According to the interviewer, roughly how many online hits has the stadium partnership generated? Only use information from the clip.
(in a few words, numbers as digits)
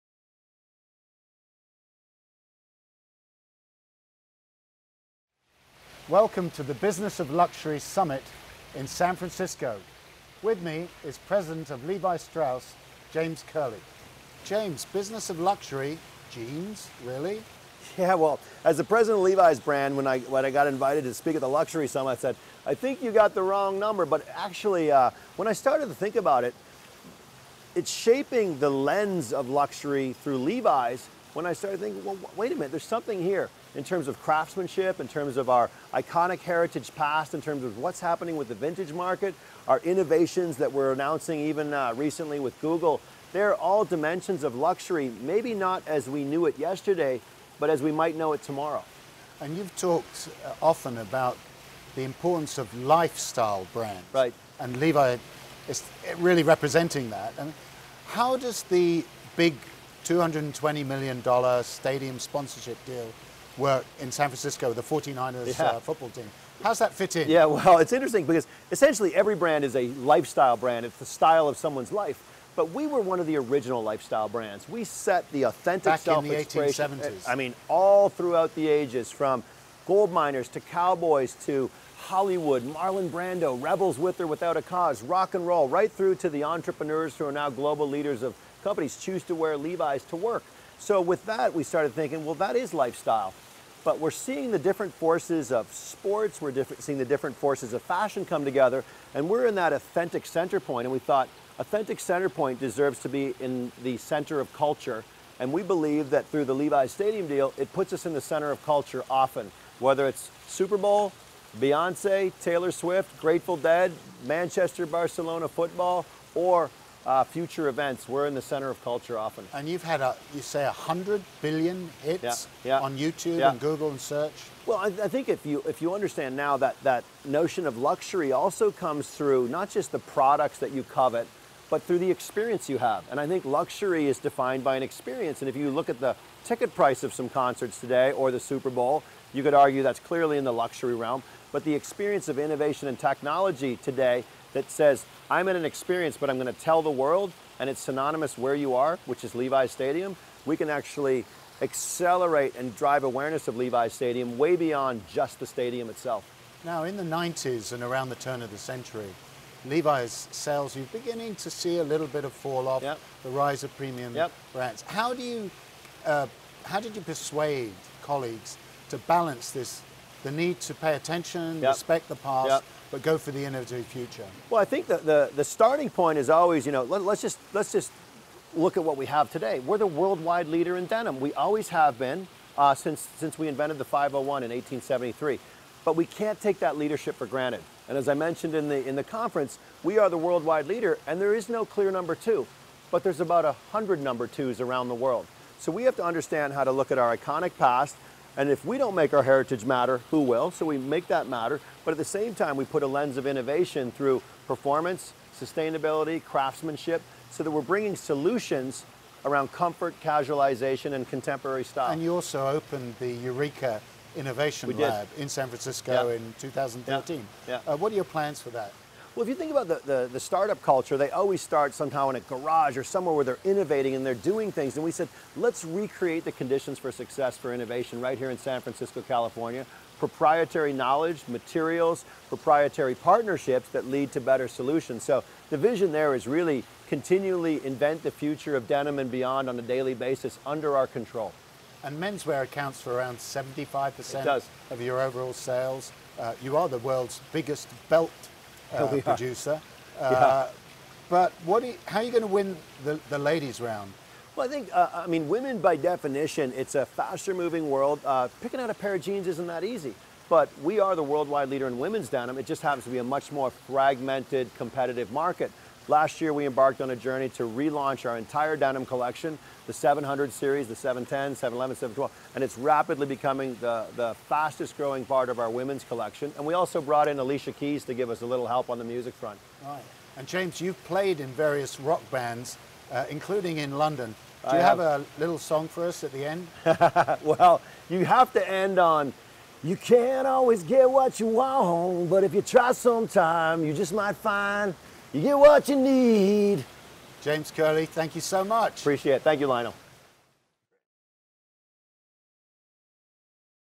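100 billion.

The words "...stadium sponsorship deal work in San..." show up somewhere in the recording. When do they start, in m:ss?
1:01.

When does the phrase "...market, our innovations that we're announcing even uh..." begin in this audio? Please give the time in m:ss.
0:38.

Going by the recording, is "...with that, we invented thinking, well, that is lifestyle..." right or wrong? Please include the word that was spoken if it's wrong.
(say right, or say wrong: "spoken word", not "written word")
wrong: "started", not "invented".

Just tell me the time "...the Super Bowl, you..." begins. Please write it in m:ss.
2:18.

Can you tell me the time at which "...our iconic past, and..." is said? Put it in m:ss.
3:16.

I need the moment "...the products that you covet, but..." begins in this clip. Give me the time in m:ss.
2:09.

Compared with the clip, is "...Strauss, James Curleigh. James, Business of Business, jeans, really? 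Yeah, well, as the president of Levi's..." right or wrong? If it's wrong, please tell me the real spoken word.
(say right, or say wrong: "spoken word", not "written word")
wrong: "Luxury", not "Business".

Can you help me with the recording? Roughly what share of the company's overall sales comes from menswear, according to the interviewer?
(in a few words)
75%.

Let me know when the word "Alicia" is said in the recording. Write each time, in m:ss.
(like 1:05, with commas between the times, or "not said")
4:37.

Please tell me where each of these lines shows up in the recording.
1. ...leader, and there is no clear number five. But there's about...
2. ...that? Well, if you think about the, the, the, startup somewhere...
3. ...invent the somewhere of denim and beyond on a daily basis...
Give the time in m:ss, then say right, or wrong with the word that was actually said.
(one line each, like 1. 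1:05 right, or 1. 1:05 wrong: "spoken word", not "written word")
1. 3:10 wrong: "two", not "five"
2. 3:38 wrong: "culture", not "somewhere"
3. 3:57 wrong: "future", not "somewhere".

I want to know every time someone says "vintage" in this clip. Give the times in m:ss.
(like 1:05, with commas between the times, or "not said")
0:38.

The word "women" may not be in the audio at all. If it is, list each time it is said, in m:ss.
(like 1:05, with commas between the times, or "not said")
4:15, 4:21, 4:35.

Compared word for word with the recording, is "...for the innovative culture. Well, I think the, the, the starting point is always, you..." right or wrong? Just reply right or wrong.
wrong.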